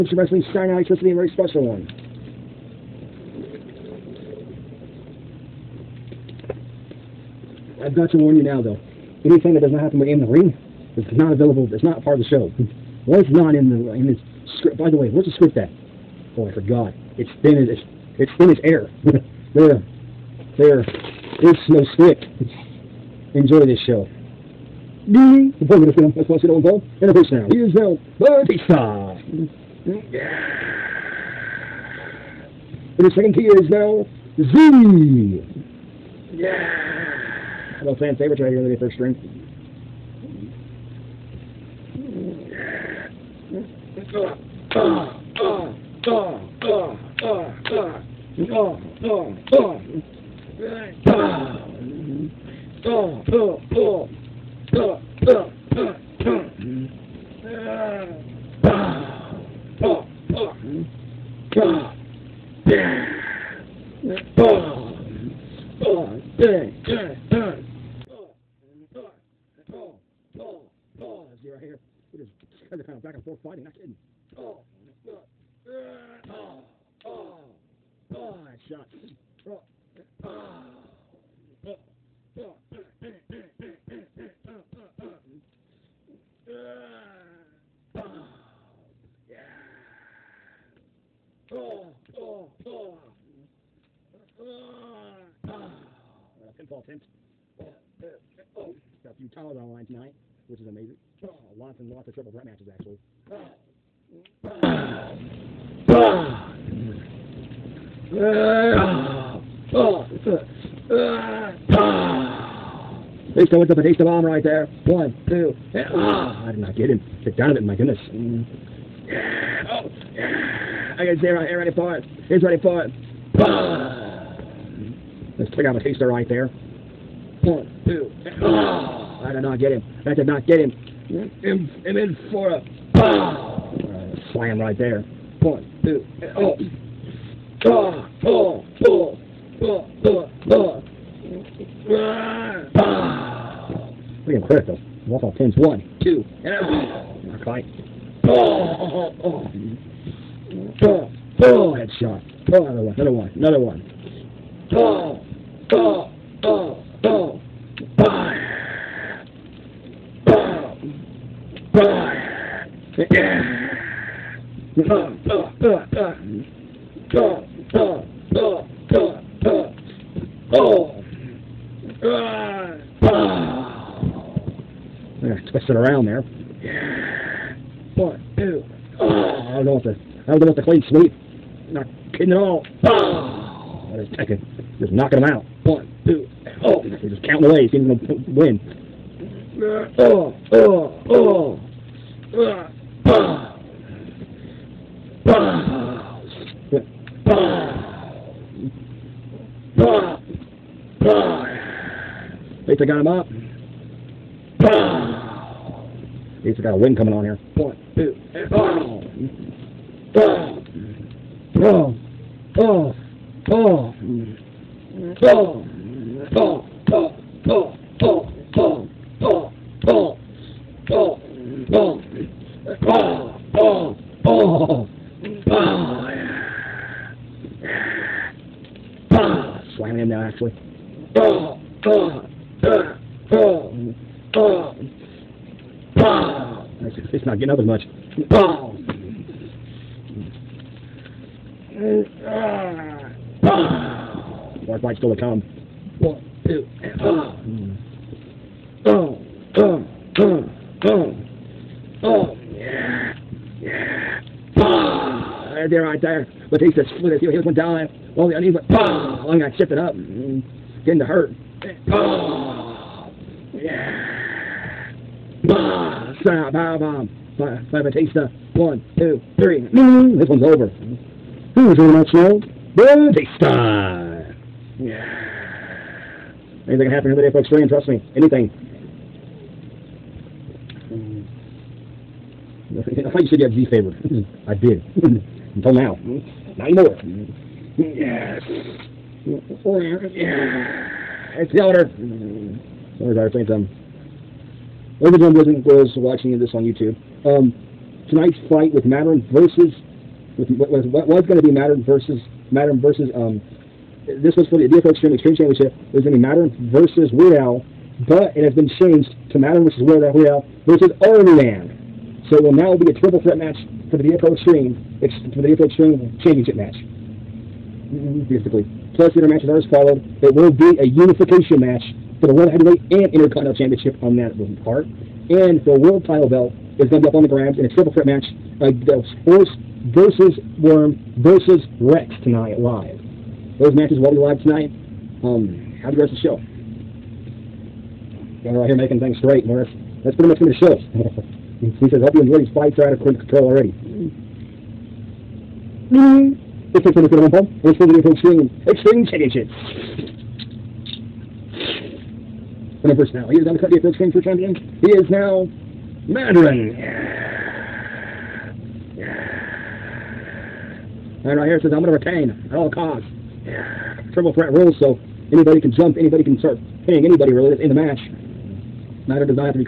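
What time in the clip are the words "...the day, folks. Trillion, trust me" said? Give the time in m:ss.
4:37.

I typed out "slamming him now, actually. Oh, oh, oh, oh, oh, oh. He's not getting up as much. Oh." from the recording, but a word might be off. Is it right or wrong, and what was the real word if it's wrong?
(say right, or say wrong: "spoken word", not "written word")
right.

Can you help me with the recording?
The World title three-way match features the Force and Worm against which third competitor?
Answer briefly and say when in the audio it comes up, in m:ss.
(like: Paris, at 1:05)
Rex, at 5:31.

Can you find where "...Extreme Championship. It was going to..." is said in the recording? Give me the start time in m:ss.
5:05.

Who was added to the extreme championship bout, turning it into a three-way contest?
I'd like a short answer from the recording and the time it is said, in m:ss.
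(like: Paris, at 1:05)
Army Man, at 5:11.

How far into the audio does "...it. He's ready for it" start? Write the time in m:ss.
2:01.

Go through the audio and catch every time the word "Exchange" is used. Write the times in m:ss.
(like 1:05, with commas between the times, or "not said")
5:53.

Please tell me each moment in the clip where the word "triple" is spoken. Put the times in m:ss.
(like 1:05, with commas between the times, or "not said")
1:42, 5:13, 5:27, 6:04.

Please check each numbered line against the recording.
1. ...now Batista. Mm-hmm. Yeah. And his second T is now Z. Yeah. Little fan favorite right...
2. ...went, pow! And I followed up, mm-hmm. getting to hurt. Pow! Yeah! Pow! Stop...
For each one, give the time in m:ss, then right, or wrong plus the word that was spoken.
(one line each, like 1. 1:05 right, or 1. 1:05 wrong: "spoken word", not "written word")
1. 0:27 right
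2. 4:18 wrong: "shifted", not "followed".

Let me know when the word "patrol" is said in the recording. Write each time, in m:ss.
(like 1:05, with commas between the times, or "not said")
not said.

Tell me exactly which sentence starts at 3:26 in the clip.
He's got a wind coming on here.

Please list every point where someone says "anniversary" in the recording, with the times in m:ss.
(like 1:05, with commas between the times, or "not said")
not said.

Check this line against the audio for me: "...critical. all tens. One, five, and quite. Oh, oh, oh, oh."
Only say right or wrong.
wrong.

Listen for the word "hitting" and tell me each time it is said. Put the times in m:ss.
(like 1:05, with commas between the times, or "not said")
6:06.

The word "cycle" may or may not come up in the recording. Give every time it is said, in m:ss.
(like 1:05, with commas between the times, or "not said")
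not said.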